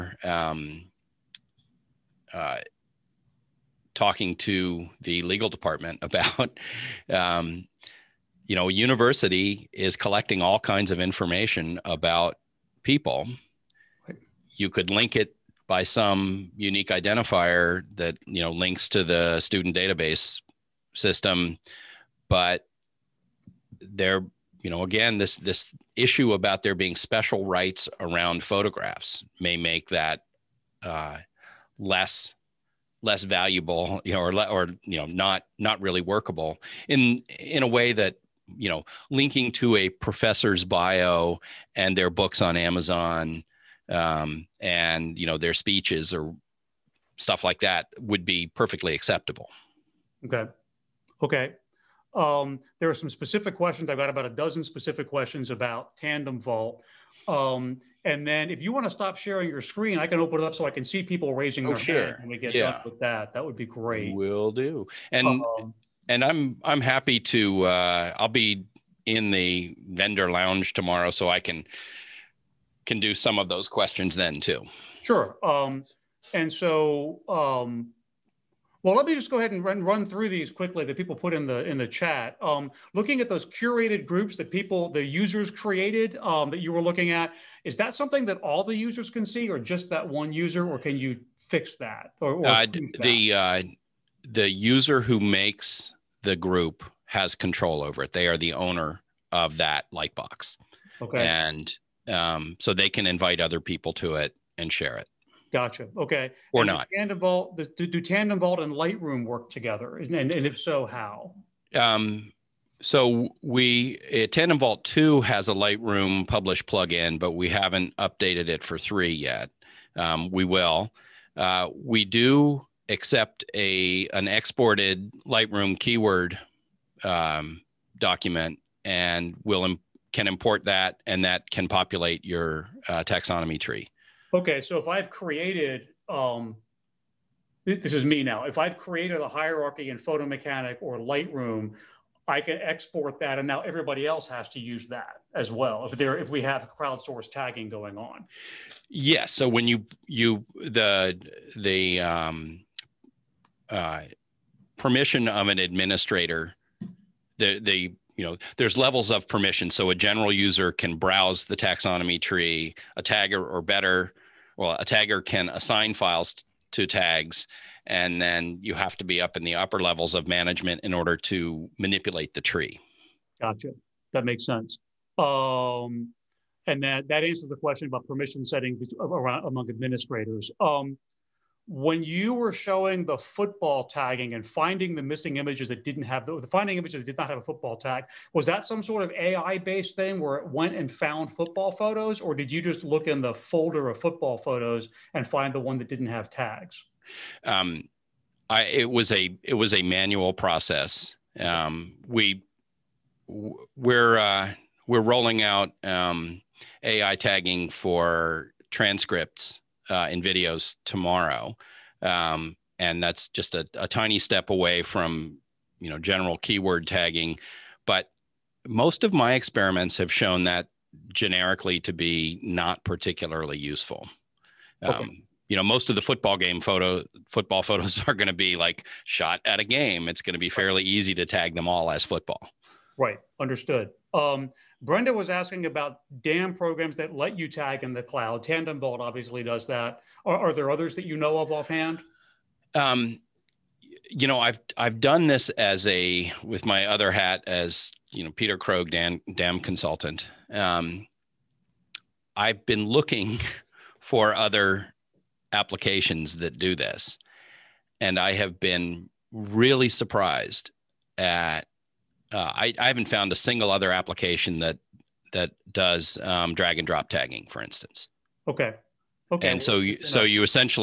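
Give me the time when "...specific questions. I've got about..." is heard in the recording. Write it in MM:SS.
00:53.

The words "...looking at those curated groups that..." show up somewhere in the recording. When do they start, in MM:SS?
01:22.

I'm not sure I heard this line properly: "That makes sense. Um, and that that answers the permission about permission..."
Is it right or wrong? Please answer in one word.
wrong.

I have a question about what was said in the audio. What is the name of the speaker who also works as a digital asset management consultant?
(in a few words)
Peter Krogh.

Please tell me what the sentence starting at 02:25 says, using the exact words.
If there, if we have crowdsource tagging going on, yes.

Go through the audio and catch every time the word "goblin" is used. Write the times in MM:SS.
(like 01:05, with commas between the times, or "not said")
not said.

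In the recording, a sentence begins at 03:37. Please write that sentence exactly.
But most of my experiments have shown that generically to be not particularly useful.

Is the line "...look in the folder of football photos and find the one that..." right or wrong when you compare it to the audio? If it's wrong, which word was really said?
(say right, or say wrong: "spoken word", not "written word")
right.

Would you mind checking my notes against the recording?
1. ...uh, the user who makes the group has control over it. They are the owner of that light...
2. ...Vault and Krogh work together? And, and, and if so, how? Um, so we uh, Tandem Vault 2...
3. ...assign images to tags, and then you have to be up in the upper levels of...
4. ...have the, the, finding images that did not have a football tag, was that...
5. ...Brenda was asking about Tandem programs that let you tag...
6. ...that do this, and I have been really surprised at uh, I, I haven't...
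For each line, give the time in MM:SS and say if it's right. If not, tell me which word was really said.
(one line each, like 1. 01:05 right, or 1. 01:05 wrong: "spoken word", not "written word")
1. 01:33 right
2. 01:48 wrong: "Lightroom", not "Krogh"
3. 02:45 wrong: "files", not "images"
4. 03:06 right
5. 03:54 wrong: "DAM", not "Tandem"
6. 04:16 right.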